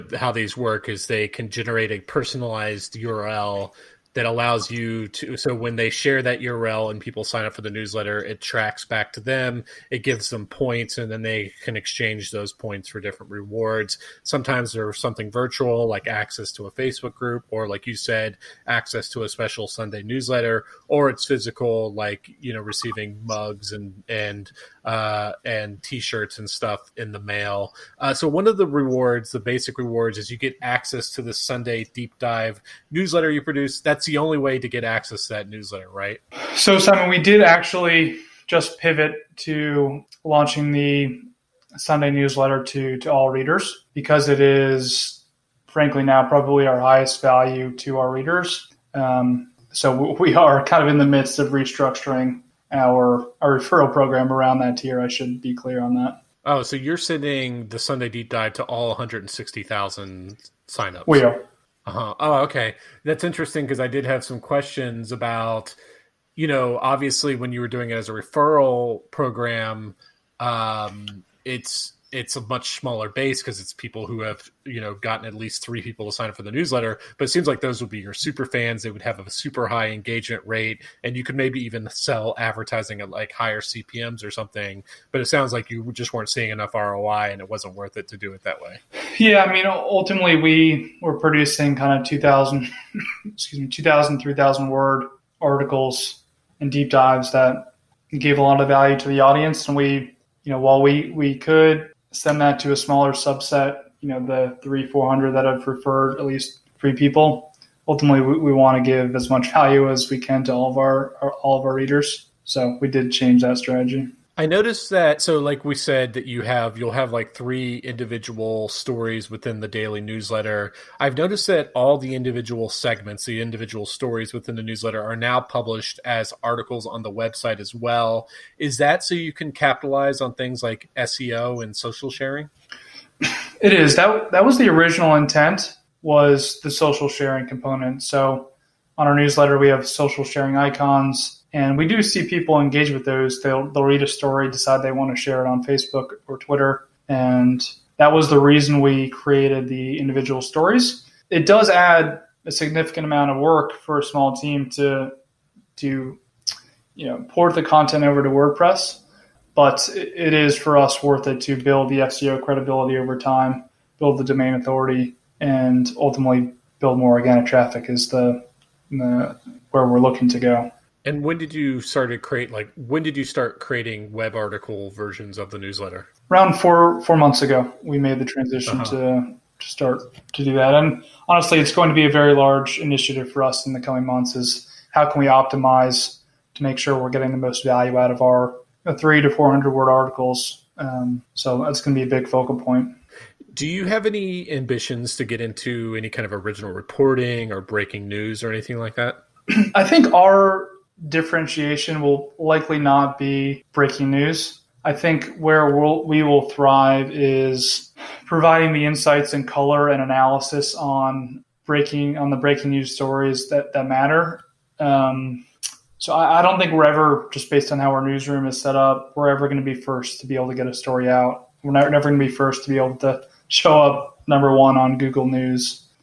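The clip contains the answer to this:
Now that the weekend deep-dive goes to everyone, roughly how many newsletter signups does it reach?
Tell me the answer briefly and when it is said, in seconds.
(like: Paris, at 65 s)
160,000, at 58 s.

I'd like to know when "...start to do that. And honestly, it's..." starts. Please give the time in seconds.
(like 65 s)
179 s.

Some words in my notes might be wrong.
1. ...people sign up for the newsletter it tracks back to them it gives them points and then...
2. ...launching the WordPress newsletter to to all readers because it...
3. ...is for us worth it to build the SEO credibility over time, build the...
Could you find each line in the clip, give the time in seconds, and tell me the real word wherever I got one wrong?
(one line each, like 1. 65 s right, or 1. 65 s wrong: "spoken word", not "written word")
1. 7 s right
2. 40 s wrong: "Sunday", not "WordPress"
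3. 160 s right.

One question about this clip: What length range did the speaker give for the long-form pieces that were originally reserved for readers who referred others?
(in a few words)
2000 to 3000 words.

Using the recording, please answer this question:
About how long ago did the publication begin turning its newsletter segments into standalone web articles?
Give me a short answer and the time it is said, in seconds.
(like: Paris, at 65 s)
4 months ago, at 176 s.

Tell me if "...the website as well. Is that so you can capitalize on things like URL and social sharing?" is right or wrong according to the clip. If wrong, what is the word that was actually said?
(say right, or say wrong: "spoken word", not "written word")
wrong: "SEO", not "URL".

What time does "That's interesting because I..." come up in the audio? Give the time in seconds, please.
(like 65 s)
63 s.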